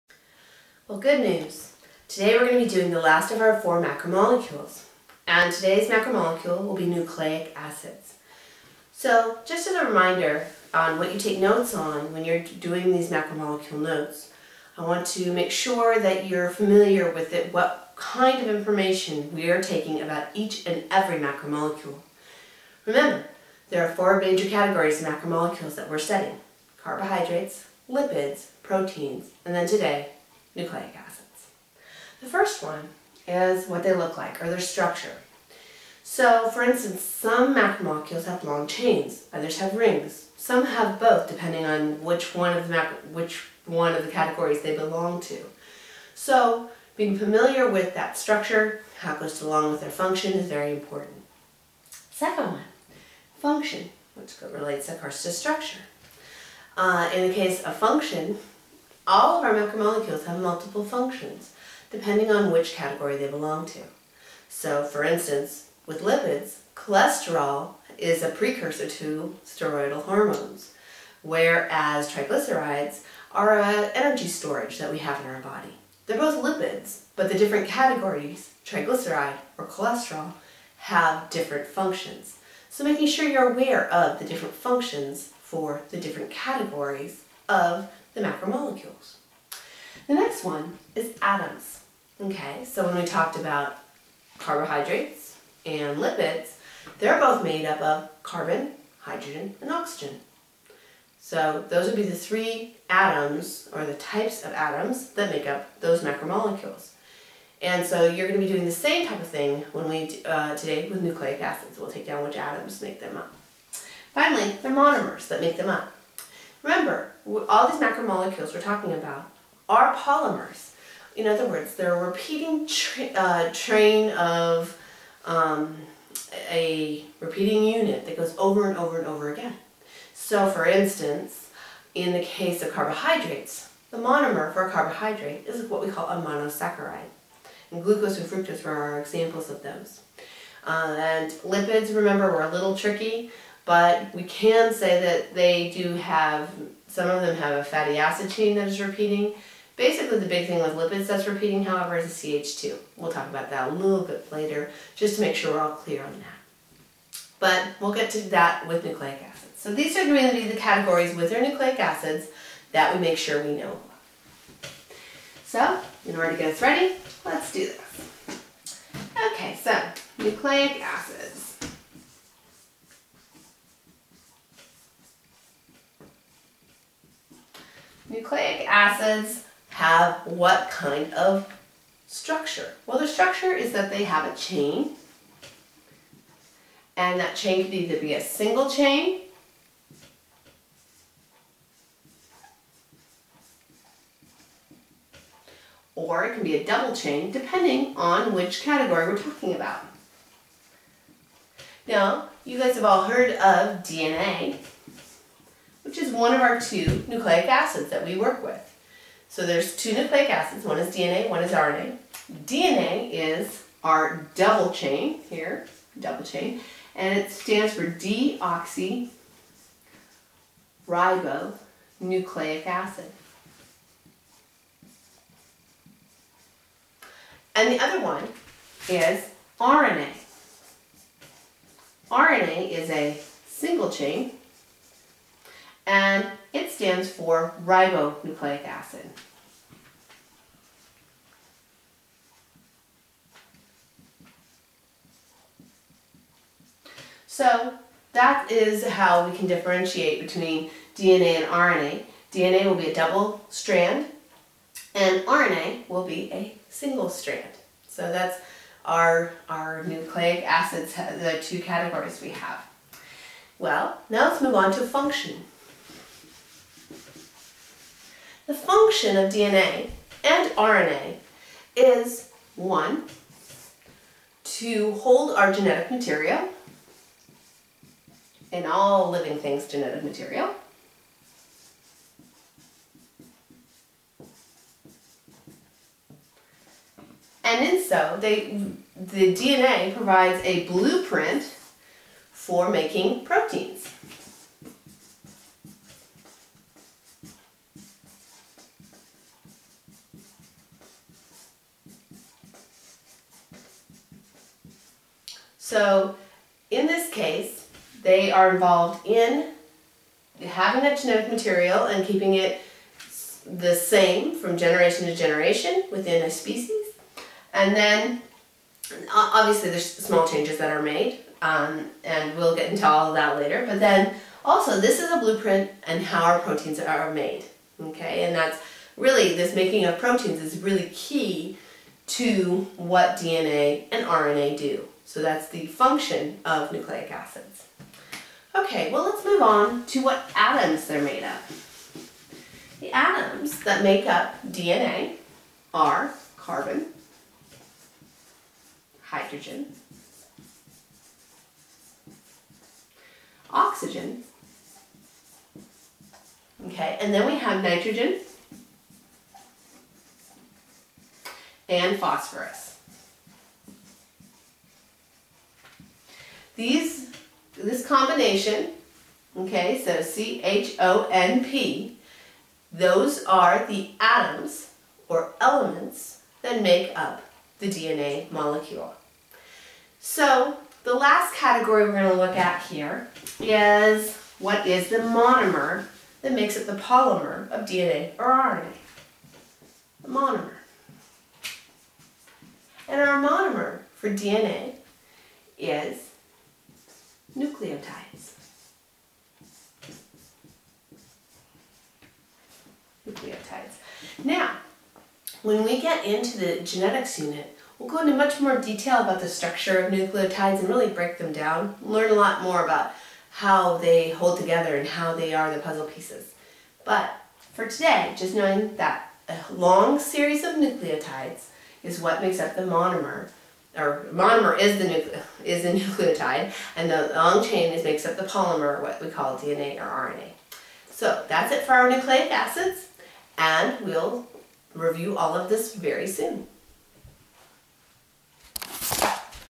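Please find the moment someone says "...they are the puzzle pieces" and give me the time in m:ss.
6:55.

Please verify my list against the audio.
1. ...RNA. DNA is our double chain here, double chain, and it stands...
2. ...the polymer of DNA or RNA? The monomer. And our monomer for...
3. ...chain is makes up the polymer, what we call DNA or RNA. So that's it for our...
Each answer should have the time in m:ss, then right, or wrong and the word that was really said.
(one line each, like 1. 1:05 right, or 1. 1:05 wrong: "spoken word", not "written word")
1. 3:31 right
2. 6:26 right
3. 7:07 right.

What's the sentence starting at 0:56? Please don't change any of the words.
Uh, in the case of function, all of our macromolecules have multiple functions, depending on which category they belong to.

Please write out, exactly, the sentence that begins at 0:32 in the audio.
The first one is what they look like or their structure.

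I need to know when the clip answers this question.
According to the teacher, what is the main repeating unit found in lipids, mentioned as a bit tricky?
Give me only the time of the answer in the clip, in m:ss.
2:32.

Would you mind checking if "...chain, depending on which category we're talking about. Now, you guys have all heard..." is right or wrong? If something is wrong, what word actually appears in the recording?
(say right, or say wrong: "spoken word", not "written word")
right.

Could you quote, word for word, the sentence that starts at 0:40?
Some have both, depending on which one of the which one of the categories they belong to.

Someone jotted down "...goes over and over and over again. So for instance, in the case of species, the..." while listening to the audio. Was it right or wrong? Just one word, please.
wrong.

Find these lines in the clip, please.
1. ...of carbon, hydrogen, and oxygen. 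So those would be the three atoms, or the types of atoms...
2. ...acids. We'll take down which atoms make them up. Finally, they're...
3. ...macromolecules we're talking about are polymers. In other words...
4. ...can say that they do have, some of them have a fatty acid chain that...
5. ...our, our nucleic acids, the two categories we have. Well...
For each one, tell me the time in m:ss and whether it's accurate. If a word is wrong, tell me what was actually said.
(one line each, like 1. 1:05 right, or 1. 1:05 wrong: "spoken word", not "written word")
1. 1:37 right
2. 1:51 right
3. 1:57 right
4. 2:24 right
5. 4:18 right.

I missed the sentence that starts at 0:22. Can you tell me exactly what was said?
Remember, there are four major categories of macromolecules that we're studying.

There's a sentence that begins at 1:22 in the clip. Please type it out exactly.
So making sure you're aware of the different functions for the different categories of the macromolecules.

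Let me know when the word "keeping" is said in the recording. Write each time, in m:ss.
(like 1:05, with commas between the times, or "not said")
5:12.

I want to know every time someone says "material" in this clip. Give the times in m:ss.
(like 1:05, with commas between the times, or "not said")
4:35, 4:40, 5:11.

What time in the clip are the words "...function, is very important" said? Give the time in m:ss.
0:49.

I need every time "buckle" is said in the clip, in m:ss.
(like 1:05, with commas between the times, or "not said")
not said.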